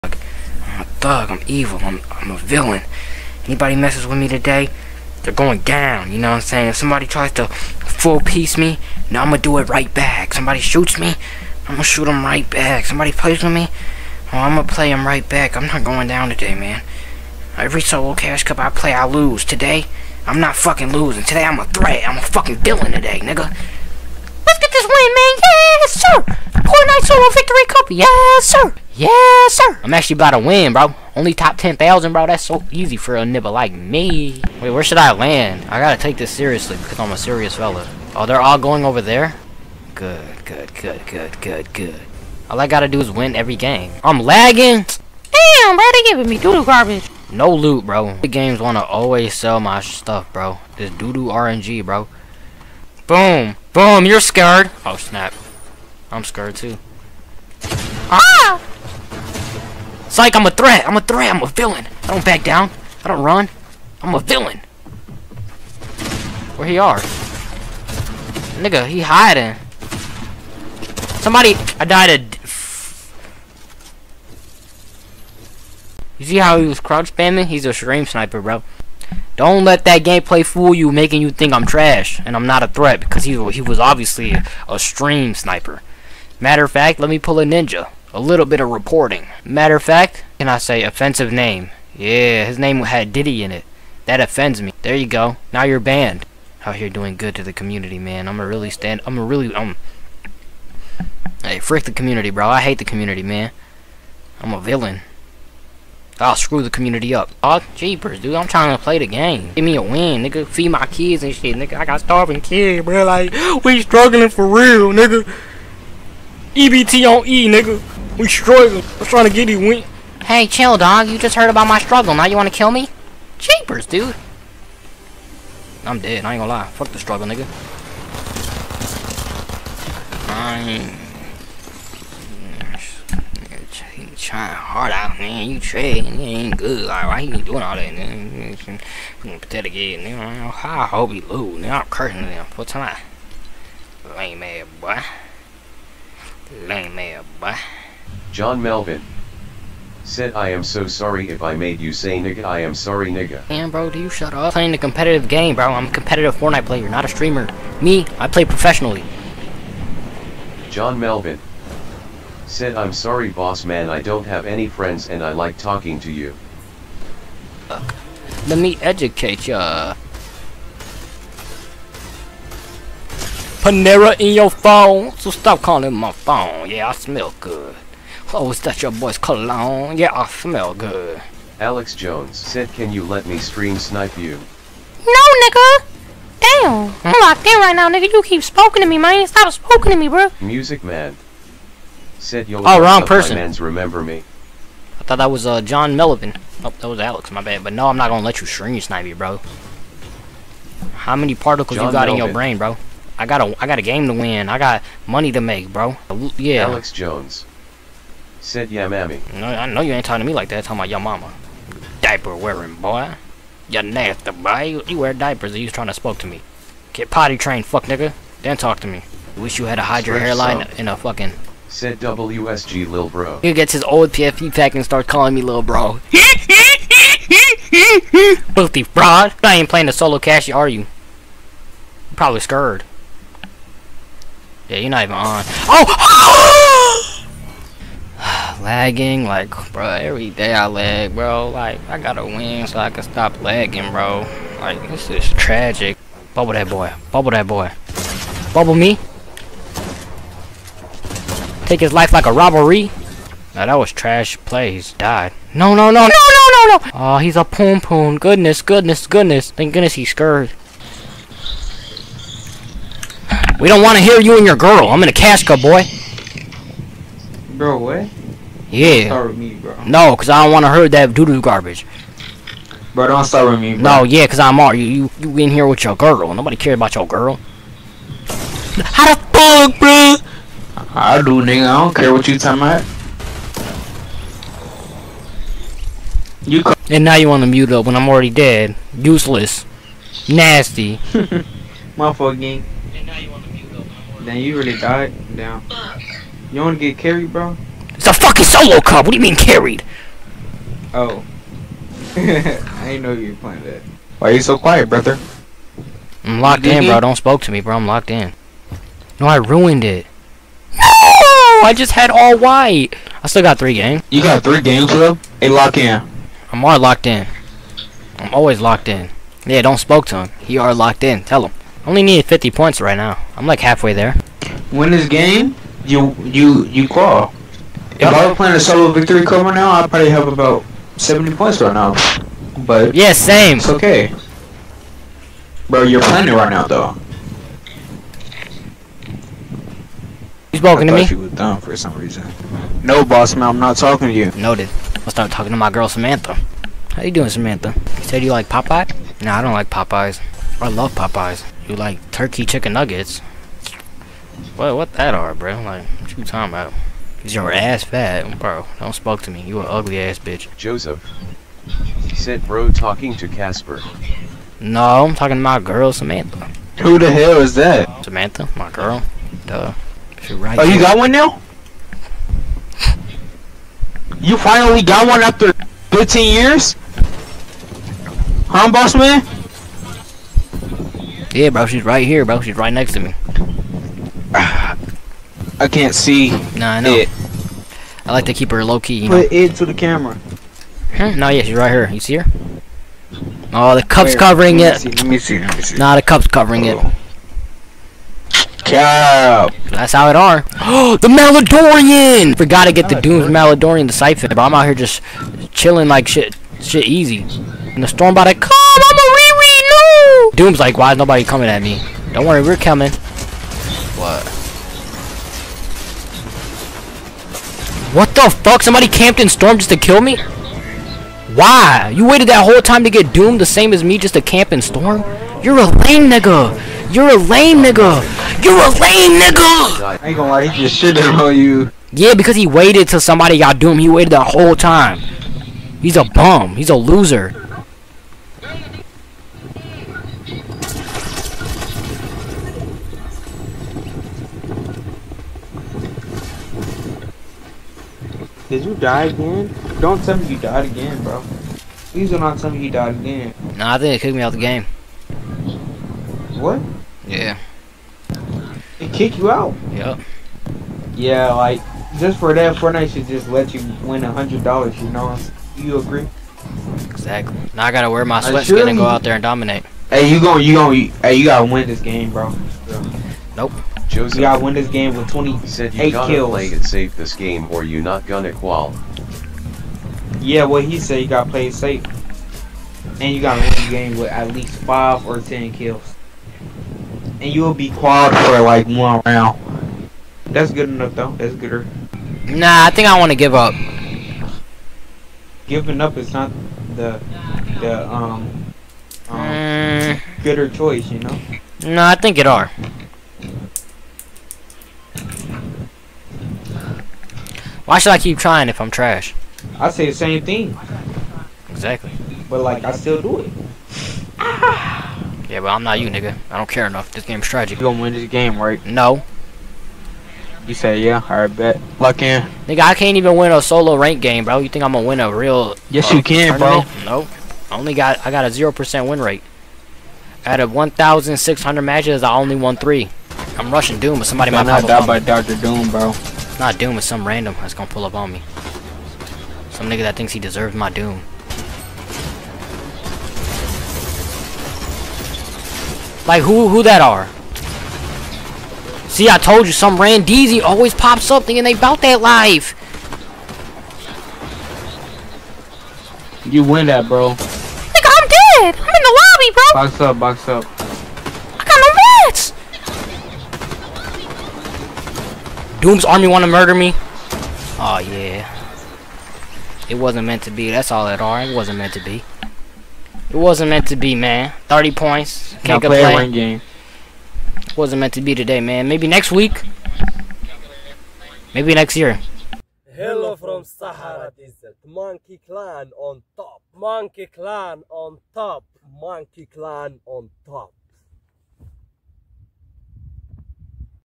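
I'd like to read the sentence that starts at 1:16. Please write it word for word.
You see how he was crouch spamming?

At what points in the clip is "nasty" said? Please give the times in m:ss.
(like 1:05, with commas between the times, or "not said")
3:33, 4:50.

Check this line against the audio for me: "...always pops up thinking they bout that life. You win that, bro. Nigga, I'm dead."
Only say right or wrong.
right.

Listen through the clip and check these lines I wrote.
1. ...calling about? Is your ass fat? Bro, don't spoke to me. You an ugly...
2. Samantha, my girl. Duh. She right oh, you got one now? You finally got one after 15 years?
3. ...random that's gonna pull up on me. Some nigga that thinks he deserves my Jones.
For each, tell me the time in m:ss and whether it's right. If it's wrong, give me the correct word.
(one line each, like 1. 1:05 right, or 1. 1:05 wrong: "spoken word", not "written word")
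1. 5:56 wrong: "talking", not "calling"
2. 6:08 right
3. 8:57 wrong: "Doom", not "Jones".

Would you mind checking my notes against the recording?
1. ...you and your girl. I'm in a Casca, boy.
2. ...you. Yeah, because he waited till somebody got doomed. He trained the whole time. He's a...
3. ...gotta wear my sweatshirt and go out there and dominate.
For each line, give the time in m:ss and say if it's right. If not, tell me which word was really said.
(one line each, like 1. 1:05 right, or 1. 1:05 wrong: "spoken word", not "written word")
1. 4:24 right
2. 7:11 wrong: "waited", not "trained"
3. 7:47 right.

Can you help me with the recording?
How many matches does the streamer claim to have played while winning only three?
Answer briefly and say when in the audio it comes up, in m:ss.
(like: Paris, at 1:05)
1,600, at 8:50.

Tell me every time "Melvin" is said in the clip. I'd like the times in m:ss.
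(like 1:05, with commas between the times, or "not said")
2:28, 2:40, 3:15, 3:22.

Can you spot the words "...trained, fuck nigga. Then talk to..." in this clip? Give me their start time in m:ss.
3:37.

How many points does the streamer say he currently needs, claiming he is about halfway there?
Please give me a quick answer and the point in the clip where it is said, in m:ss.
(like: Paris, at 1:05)
50, at 5:22.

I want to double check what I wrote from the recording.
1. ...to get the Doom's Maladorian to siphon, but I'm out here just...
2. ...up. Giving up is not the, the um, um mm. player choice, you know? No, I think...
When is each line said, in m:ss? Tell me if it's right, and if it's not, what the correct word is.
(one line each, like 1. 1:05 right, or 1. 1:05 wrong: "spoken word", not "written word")
1. 6:42 right
2. 8:13 wrong: "gooder", not "player".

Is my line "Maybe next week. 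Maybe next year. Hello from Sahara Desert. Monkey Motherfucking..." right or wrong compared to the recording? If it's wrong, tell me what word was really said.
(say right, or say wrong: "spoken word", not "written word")
wrong: "Clan", not "Motherfucking".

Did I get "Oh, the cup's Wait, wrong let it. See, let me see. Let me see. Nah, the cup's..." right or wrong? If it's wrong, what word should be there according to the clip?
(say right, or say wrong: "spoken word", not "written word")
wrong: "covering", not "wrong".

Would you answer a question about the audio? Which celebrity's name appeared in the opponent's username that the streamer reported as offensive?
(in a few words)
Diddy.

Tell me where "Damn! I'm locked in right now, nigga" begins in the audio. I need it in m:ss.
3:06.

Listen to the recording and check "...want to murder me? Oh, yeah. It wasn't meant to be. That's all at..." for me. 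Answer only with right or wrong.
right.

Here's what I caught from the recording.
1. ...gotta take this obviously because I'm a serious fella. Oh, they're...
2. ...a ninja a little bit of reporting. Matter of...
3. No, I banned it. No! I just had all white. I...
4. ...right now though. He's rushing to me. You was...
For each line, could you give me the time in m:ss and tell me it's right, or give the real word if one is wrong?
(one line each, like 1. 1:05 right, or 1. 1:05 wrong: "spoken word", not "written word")
1. 0:35 wrong: "seriously", not "obviously"
2. 1:27 right
3. 5:09 wrong: "ruined", not "banned"
4. 5:36 wrong: "talking", not "rushing".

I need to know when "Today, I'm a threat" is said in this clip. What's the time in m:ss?
0:21.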